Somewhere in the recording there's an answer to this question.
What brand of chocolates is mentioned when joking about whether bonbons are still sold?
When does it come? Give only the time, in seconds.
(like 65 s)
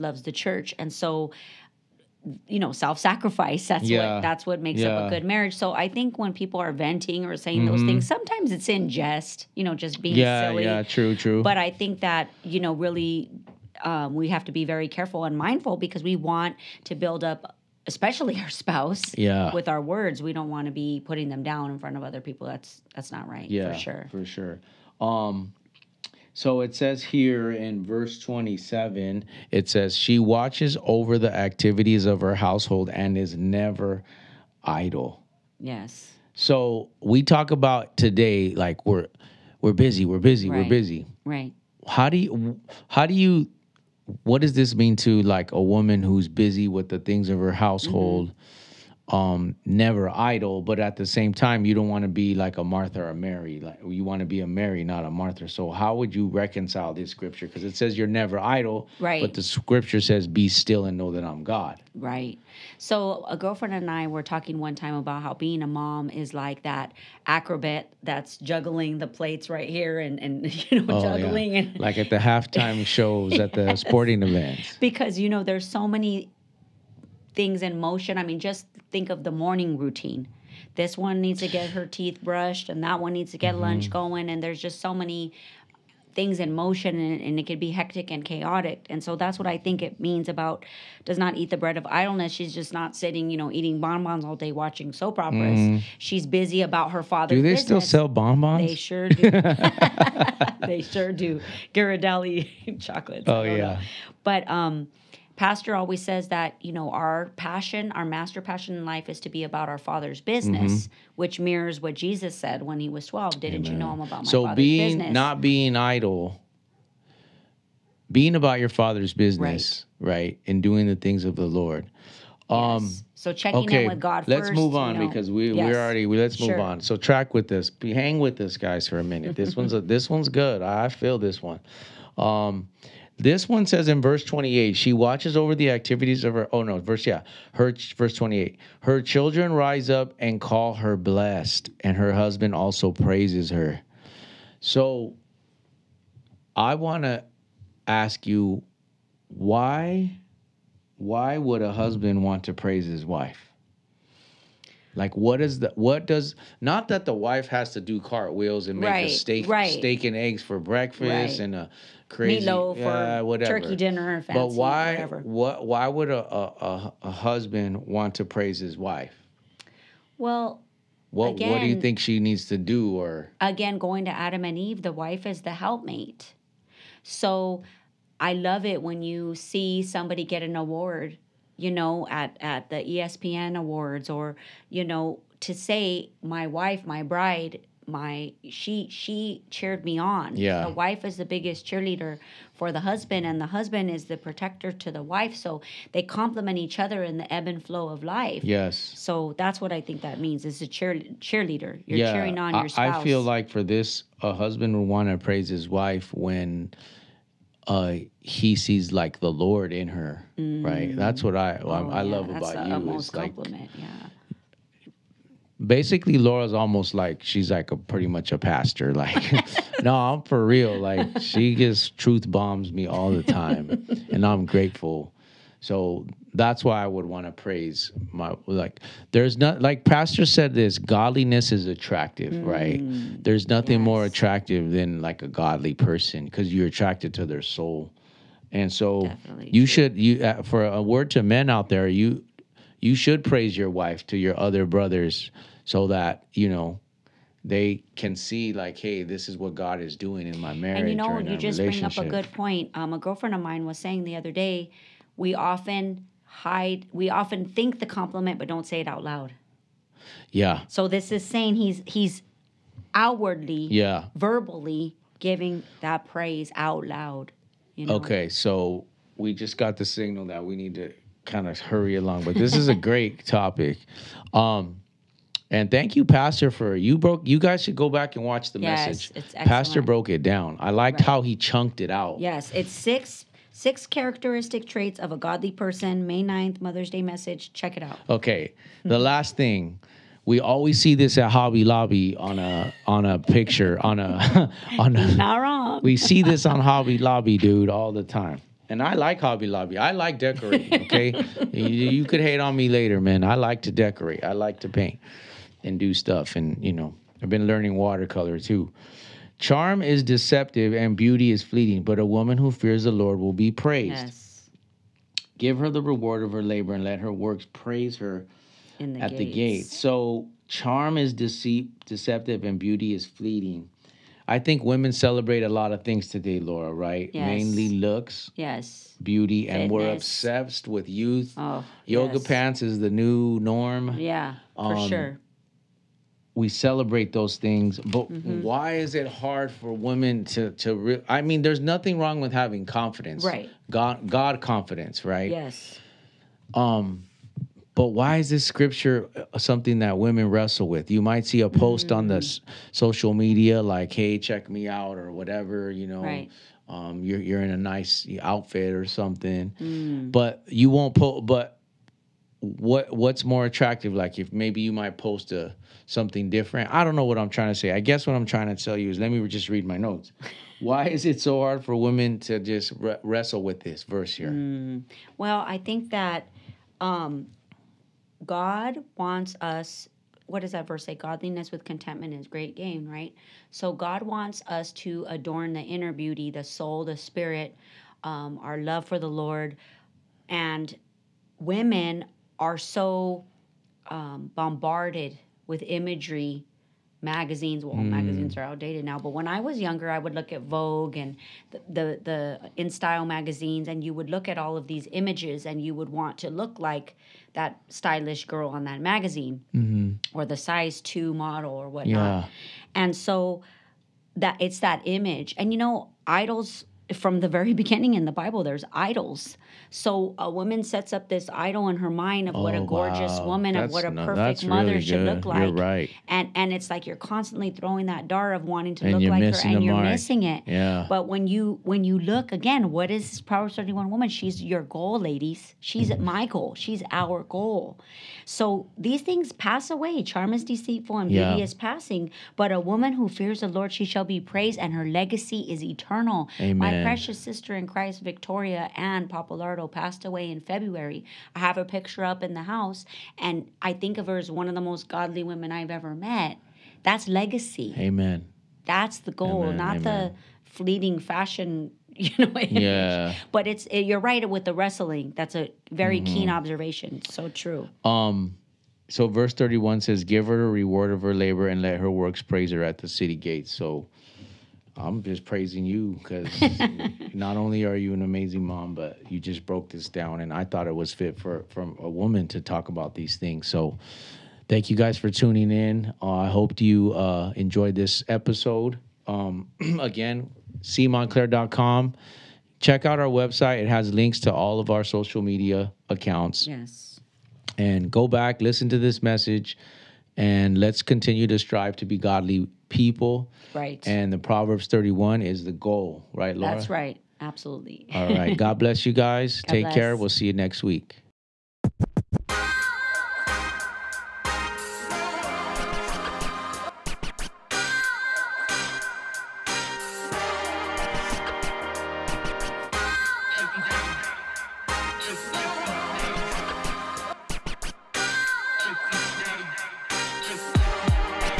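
101 s.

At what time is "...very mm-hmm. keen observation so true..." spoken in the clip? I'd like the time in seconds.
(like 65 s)
465 s.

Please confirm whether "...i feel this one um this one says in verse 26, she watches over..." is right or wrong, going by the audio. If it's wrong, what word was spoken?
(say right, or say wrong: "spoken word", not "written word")
wrong: "28", not "26".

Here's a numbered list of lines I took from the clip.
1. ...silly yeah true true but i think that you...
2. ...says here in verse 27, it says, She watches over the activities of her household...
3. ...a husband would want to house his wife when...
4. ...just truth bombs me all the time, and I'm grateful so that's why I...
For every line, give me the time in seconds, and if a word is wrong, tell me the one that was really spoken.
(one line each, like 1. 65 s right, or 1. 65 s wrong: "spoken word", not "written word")
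1. 10 s right
2. 26 s right
3. 204 s wrong: "praise", not "house"
4. 221 s right.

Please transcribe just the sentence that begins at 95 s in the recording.
she's busy about her father do they business.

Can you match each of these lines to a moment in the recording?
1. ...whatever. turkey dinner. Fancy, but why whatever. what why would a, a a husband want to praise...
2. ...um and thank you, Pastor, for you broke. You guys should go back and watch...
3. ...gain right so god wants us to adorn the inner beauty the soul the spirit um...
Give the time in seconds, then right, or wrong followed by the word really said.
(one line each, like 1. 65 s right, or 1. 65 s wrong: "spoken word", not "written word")
1. 163 s right
2. 274 s right
3. 382 s right.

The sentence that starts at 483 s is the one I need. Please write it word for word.
So, thank you guys for tuning in.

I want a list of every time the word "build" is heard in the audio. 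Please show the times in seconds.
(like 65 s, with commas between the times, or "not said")
16 s.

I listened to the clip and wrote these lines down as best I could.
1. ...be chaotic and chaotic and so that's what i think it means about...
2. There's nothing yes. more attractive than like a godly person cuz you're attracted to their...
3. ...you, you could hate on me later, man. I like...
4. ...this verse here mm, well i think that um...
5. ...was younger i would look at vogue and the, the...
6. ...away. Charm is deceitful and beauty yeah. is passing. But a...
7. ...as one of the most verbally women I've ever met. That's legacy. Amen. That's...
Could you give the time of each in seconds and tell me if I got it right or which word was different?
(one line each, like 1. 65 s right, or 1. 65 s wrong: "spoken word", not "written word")
1. 87 s wrong: "hectic", not "chaotic"
2. 233 s right
3. 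301 s right
4. 373 s right
5. 399 s right
6. 439 s right
7. 454 s wrong: "godly", not "verbally".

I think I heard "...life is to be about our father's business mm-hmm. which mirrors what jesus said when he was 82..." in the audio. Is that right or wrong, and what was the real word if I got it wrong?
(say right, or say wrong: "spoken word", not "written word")
wrong: "12", not "82".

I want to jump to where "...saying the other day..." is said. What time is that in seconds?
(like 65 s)
253 s.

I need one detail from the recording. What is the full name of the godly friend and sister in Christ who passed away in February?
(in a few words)
Victoria Ann Papalardo.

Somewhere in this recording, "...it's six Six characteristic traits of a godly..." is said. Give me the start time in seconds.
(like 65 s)
282 s.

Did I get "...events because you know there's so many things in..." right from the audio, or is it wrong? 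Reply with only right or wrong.
right.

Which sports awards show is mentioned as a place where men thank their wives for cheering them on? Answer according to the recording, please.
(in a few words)
ESPN awards.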